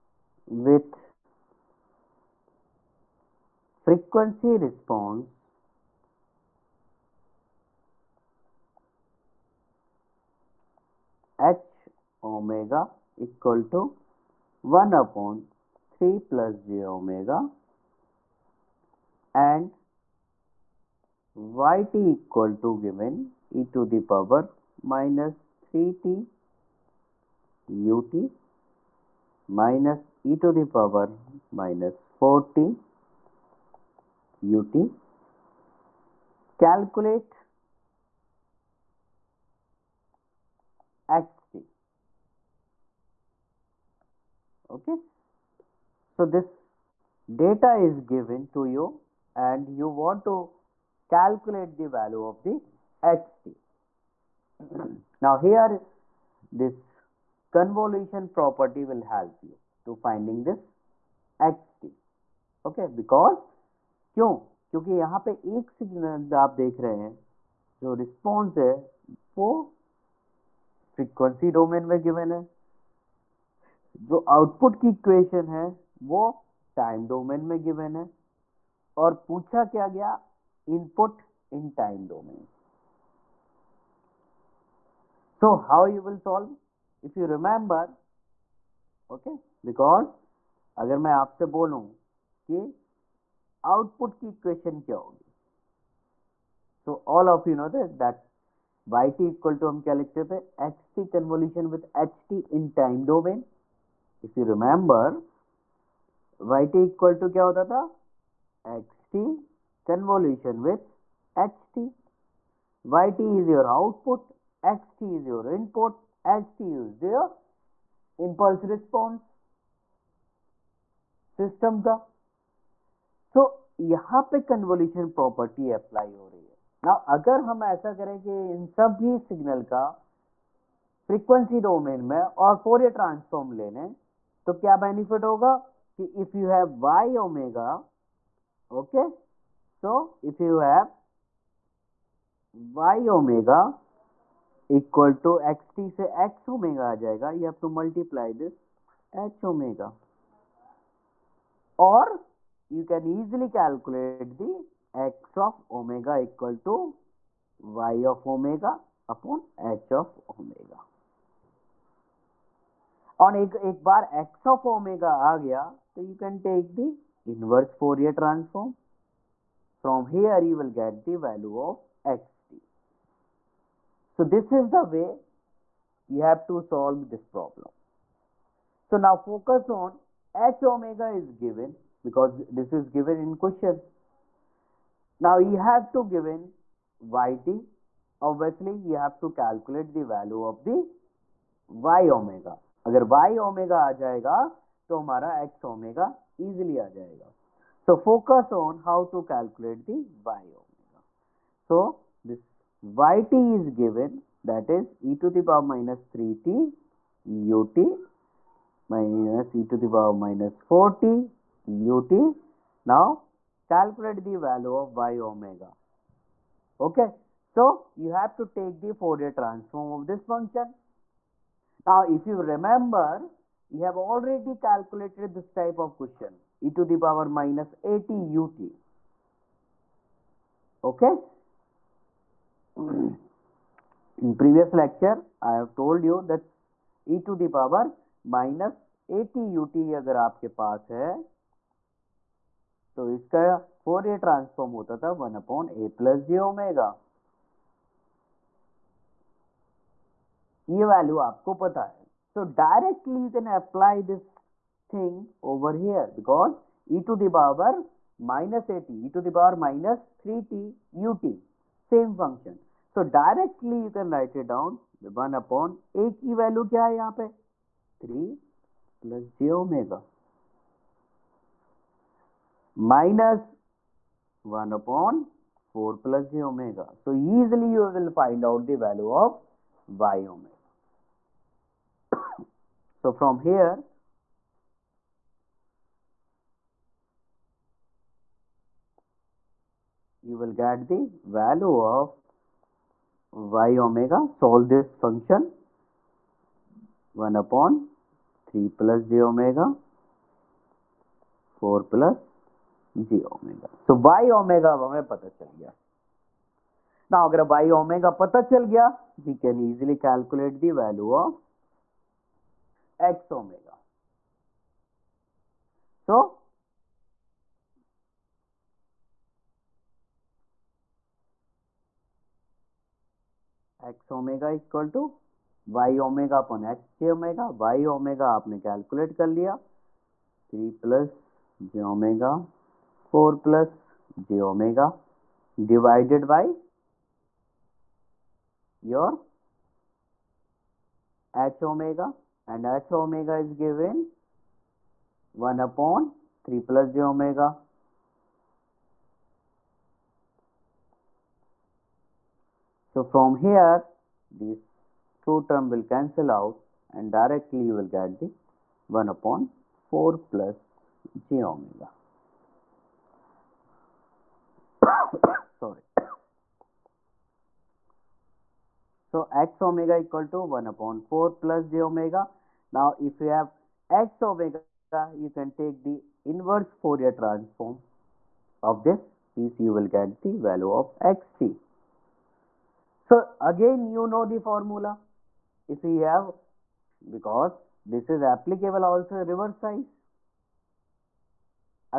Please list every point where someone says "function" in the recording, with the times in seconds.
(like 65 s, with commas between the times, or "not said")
220 s, 294 s.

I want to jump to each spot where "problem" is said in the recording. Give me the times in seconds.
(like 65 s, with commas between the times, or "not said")
177 s.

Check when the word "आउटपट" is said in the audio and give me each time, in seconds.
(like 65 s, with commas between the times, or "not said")
74 s, 93 s, 113 s.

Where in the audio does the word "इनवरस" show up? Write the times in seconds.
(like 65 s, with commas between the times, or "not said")
167 s.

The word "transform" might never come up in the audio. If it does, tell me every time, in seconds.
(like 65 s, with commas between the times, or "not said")
219 s, 377 s.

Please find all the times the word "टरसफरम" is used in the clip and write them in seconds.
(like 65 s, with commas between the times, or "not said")
132 s, 168 s, 244 s.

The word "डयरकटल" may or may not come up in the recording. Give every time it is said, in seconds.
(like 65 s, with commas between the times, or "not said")
252 s, 263 s.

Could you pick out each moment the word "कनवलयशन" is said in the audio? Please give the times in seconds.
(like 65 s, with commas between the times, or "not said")
101 s, 109 s, 124 s.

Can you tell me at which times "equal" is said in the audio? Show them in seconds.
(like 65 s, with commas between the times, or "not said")
13 s, 22 s, 369 s.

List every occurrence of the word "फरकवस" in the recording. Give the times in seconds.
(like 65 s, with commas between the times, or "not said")
70 s, 131 s.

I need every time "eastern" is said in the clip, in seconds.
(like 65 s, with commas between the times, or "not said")
not said.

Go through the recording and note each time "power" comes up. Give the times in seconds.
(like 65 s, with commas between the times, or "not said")
24 s, 30 s, 205 s, 209 s, 226 s, 237 s.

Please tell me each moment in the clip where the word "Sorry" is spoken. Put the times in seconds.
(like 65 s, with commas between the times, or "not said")
365 s.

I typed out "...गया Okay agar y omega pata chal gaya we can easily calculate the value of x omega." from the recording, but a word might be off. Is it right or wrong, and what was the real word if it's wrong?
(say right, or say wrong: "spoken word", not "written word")
wrong: "Now", not "Okay".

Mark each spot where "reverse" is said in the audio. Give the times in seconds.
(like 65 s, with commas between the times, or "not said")
389 s.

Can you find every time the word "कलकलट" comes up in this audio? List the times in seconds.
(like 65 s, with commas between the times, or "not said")
153 s, 328 s.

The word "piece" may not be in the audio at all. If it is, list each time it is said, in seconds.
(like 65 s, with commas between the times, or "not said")
379 s.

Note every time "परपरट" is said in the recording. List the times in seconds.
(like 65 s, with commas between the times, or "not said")
125 s.